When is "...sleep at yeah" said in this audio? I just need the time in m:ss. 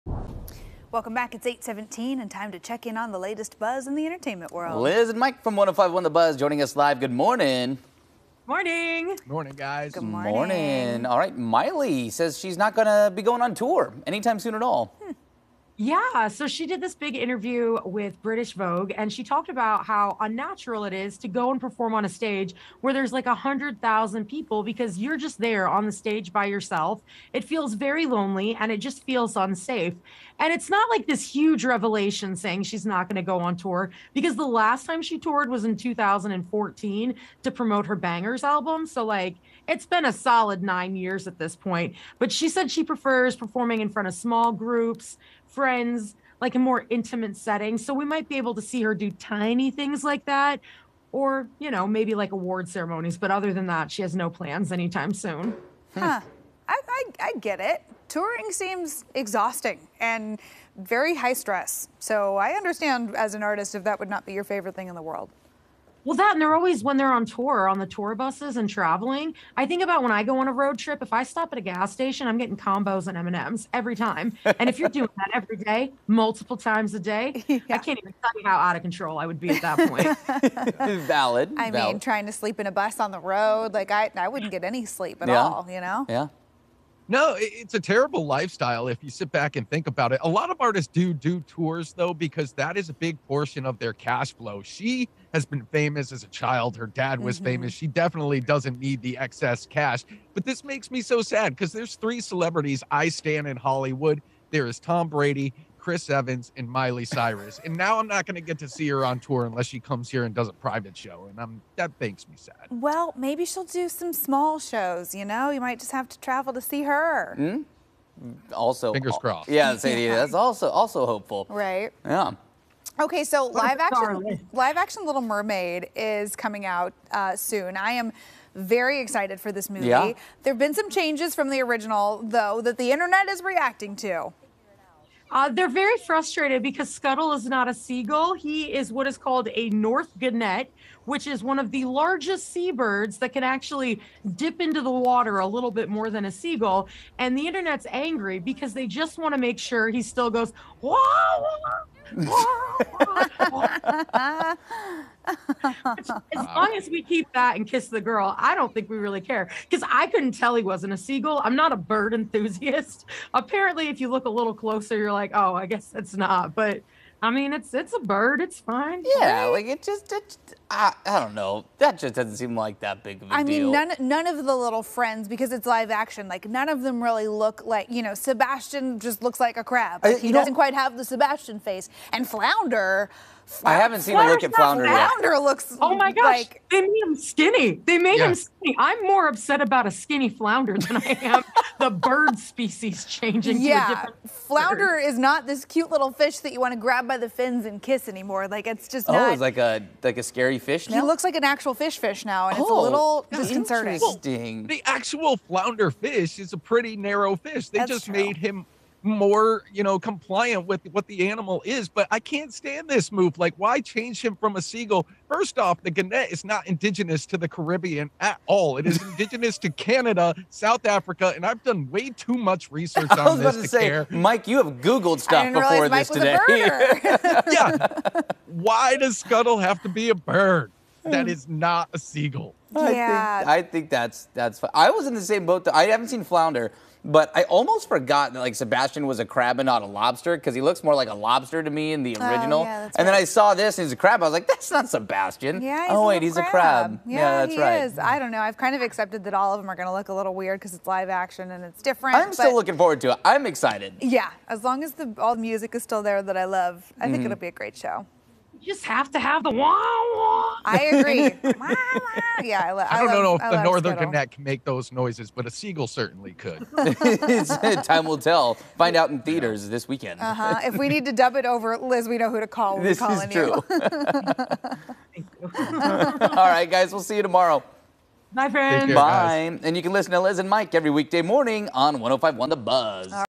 1:24.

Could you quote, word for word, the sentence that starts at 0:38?
So like, it's been a solid nine years at this point.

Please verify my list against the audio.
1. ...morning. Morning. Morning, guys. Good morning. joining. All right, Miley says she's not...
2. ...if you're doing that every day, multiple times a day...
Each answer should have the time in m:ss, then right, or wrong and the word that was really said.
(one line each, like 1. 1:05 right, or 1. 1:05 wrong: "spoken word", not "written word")
1. 0:07 wrong: "morning", not "joining"
2. 1:14 right.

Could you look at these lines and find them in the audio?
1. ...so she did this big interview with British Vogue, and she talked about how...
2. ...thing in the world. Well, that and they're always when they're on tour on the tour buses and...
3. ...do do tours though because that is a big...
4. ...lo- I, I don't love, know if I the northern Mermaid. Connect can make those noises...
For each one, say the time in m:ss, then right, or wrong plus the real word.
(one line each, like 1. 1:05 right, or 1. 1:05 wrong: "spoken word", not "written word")
1. 0:16 right
2. 1:04 right
3. 1:30 right
4. 4:22 wrong: "Scuttle", not "Mermaid".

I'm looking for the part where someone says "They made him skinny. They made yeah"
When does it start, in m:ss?
3:06.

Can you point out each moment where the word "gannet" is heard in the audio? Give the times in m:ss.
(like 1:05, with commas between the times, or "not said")
2:20, 3:35.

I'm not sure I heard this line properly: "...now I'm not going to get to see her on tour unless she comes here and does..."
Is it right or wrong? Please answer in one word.
right.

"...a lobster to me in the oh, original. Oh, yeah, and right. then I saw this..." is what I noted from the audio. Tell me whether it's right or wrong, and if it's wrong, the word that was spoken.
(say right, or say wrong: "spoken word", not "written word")
right.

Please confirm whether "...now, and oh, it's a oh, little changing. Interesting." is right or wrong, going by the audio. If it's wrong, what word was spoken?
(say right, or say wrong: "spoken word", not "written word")
wrong: "disconcerting", not "changing".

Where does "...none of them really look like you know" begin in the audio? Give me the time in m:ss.
2:56.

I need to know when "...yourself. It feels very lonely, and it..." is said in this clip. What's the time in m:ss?
0:26.